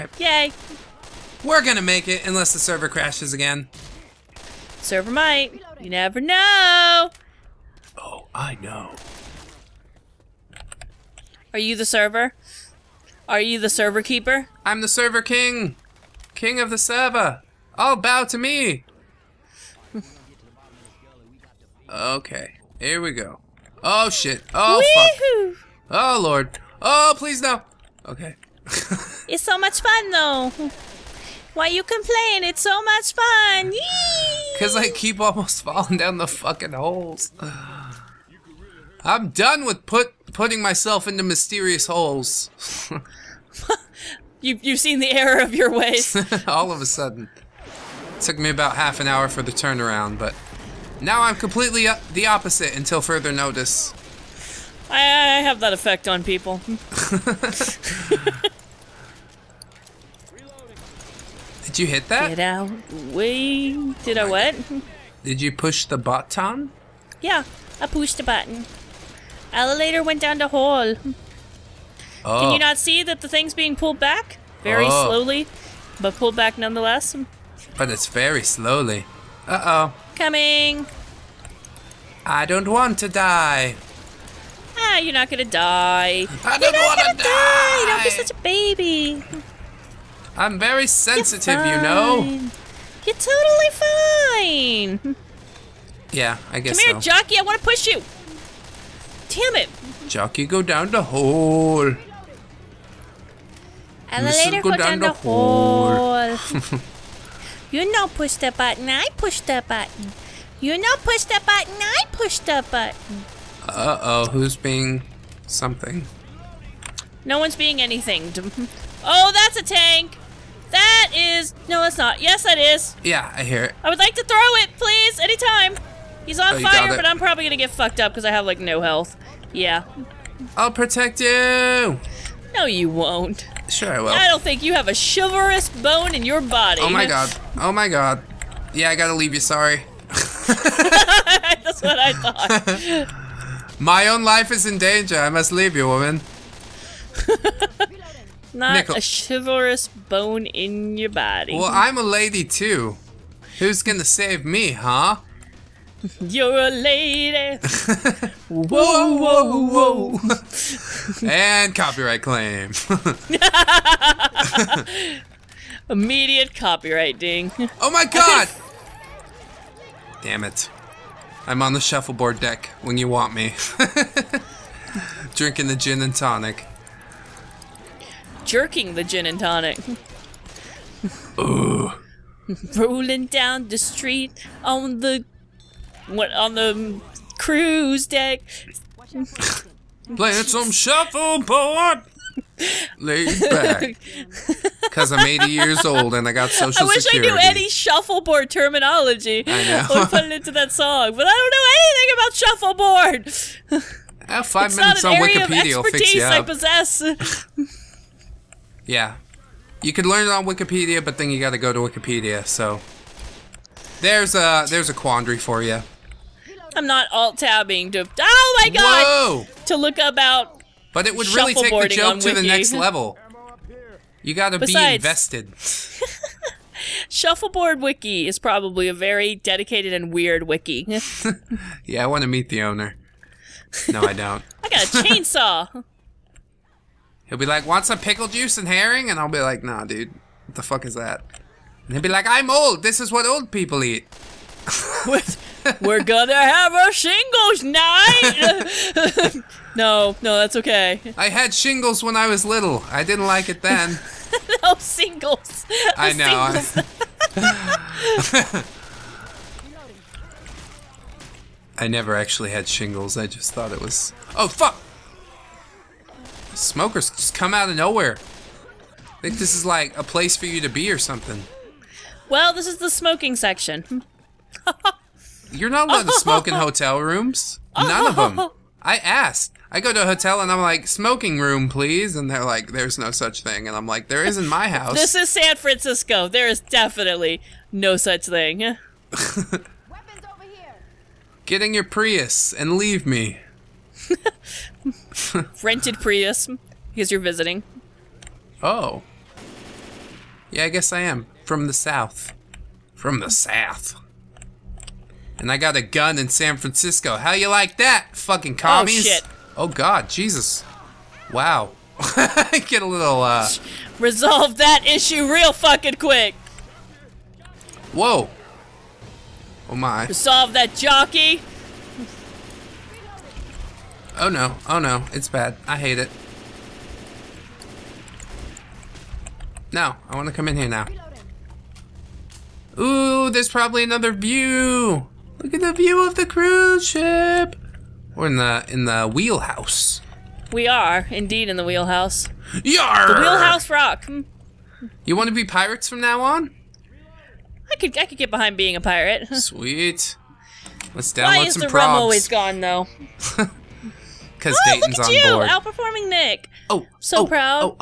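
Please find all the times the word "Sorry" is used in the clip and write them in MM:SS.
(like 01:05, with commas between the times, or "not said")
02:19.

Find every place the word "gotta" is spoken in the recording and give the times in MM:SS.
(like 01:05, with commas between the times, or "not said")
02:18, 03:44.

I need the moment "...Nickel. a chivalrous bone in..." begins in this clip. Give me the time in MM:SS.
02:28.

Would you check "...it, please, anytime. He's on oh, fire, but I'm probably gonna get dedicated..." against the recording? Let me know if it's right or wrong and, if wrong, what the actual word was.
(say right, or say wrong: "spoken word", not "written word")
wrong: "fucked", not "dedicated".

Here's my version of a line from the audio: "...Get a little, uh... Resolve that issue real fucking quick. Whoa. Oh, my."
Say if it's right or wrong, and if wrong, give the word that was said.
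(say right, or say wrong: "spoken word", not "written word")
right.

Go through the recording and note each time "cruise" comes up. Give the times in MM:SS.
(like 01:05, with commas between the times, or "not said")
03:07, 05:36.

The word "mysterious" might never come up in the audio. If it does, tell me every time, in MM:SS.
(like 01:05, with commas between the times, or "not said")
00:41.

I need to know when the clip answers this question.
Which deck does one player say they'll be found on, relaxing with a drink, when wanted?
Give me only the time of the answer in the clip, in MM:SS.
02:51.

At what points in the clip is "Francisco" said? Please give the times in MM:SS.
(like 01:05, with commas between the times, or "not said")
04:45, 05:06.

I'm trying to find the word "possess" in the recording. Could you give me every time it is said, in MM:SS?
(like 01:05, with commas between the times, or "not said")
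03:26.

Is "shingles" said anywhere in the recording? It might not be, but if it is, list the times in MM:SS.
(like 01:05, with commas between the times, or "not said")
04:06, 04:11, 04:22.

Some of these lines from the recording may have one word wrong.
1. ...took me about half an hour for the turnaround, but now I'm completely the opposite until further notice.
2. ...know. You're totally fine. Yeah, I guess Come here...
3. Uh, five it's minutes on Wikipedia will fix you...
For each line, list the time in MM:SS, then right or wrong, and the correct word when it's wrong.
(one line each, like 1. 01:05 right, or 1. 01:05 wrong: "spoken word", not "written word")
1. 00:48 right
2. 01:31 right
3. 03:24 right.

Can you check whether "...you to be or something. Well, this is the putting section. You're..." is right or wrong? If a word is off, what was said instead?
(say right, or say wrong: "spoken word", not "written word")
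wrong: "smoking", not "putting".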